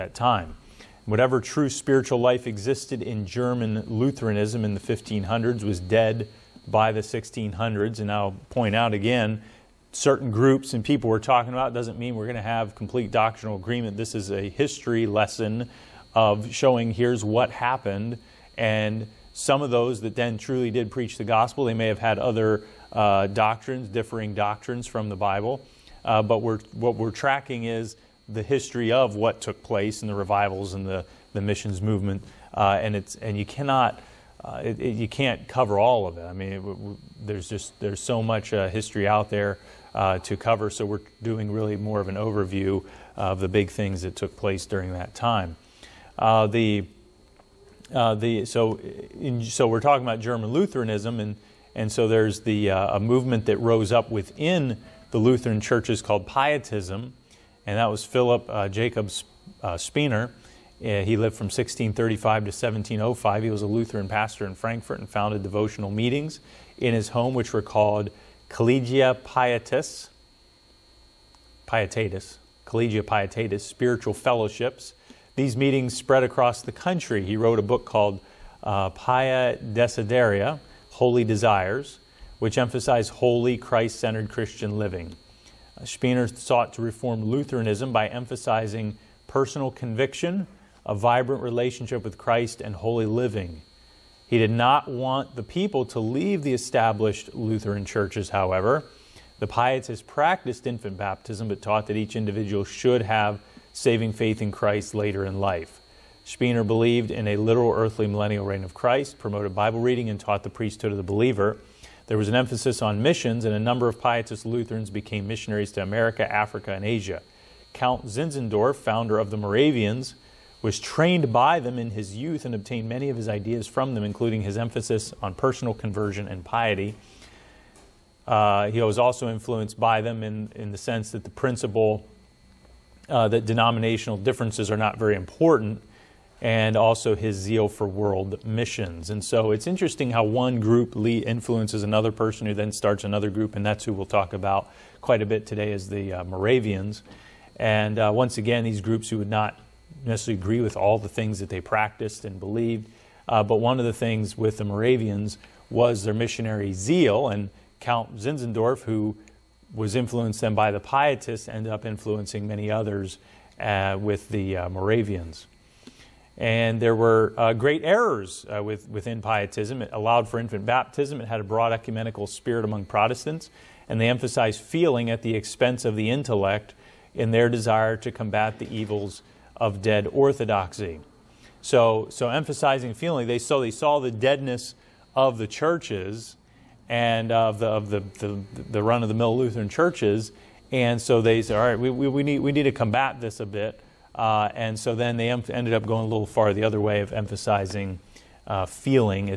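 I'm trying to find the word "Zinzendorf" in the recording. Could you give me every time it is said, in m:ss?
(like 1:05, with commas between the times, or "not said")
1:58, 2:38.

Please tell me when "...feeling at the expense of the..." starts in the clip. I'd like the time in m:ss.
2:54.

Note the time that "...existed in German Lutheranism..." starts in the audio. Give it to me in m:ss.
0:02.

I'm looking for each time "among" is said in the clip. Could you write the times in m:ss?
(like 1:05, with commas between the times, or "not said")
2:52.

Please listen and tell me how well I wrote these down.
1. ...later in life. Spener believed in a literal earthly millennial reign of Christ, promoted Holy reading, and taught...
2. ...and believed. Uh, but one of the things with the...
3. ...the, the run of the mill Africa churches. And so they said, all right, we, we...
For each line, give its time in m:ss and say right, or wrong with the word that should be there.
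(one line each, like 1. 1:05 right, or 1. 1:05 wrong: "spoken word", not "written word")
1. 1:44 wrong: "Bible", not "Holy"
2. 2:32 right
3. 3:08 wrong: "Lutheran", not "Africa".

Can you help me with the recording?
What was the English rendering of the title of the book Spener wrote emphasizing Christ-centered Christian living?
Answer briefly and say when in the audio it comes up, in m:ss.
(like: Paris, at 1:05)
Holy Desires, at 1:20.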